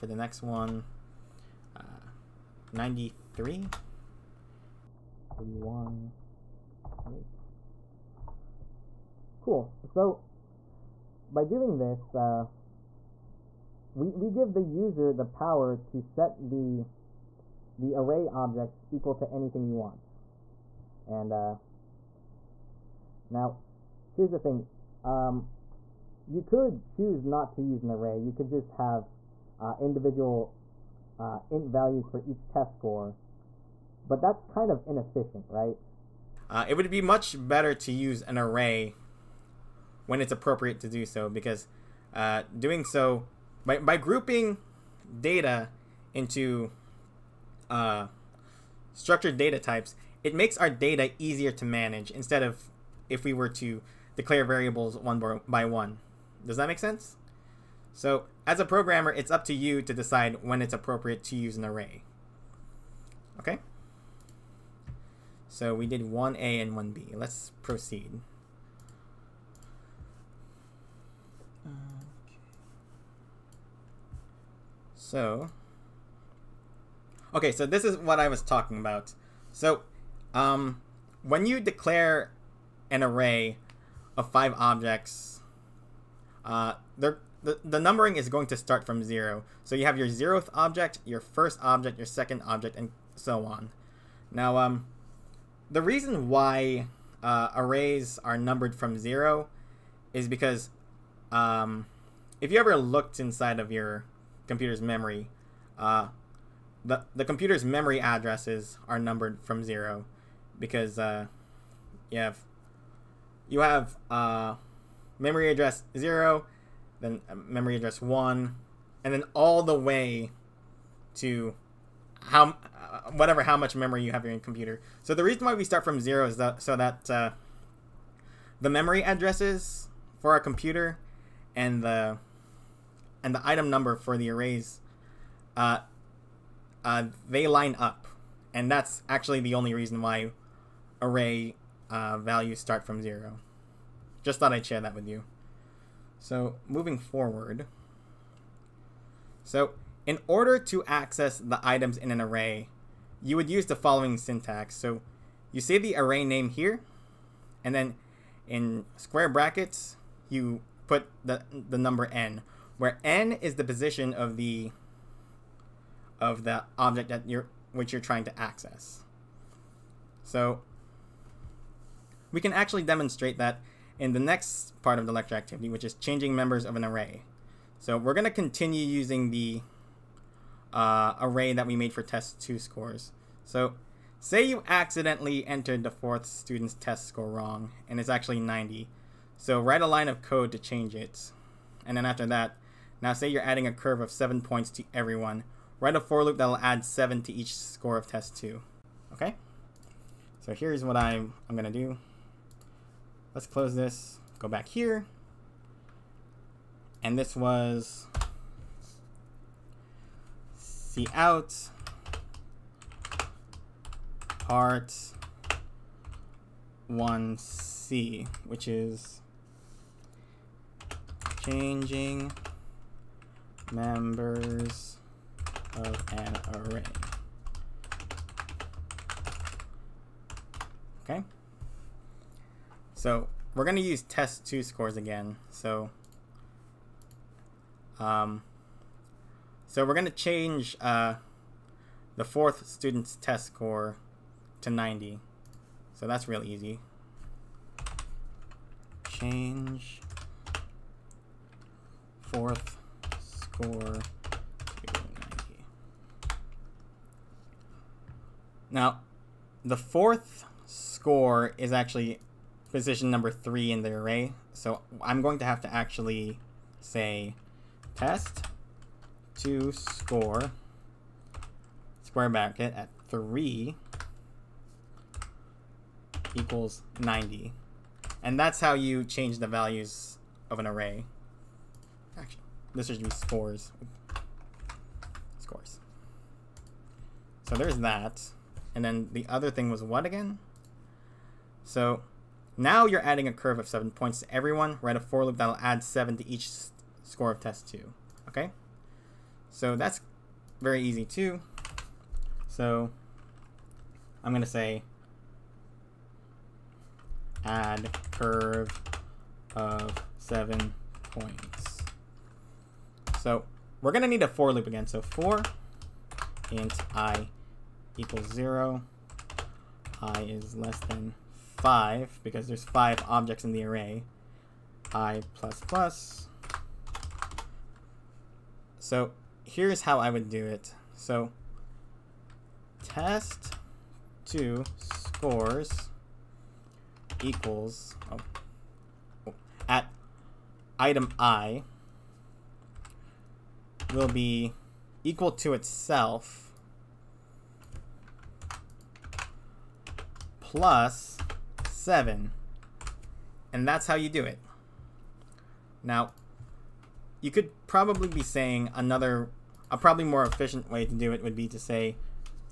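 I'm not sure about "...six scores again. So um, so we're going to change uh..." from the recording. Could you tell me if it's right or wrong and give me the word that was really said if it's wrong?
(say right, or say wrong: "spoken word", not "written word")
wrong: "two", not "six".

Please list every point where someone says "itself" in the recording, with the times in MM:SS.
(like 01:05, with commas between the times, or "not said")
05:45.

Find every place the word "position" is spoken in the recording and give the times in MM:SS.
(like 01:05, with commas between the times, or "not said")
02:43, 04:22.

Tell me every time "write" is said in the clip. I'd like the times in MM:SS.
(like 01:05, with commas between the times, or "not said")
03:09, 03:15, 04:54.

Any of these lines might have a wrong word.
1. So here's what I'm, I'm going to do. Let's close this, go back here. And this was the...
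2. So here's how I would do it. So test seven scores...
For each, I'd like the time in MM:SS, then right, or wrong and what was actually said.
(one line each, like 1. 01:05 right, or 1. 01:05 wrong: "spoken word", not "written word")
1. 03:20 right
2. 05:28 wrong: "two", not "seven".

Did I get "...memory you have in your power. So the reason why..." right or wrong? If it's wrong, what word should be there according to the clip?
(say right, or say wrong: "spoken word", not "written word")
wrong: "computer", not "power".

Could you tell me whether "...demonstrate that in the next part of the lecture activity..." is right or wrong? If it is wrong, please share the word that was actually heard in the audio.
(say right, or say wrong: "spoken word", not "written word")
right.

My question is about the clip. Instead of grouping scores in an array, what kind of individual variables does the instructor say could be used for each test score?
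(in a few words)
int values.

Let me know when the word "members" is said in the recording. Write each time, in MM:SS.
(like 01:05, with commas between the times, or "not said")
02:56, 03:43.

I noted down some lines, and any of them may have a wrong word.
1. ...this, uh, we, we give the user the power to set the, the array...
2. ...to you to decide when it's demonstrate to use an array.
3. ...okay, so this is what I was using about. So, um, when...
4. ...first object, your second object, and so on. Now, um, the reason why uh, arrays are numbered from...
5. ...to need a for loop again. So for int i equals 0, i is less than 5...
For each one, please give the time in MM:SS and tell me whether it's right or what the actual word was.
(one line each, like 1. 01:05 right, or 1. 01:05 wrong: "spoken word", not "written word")
1. 00:11 right
2. 00:59 wrong: "appropriate", not "demonstrate"
3. 01:17 wrong: "talking", not "using"
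4. 01:31 right
5. 05:14 right.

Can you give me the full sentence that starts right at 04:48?
And then the other thing was what again?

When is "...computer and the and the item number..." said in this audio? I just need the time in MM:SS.
02:10.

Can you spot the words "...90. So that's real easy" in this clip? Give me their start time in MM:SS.
04:04.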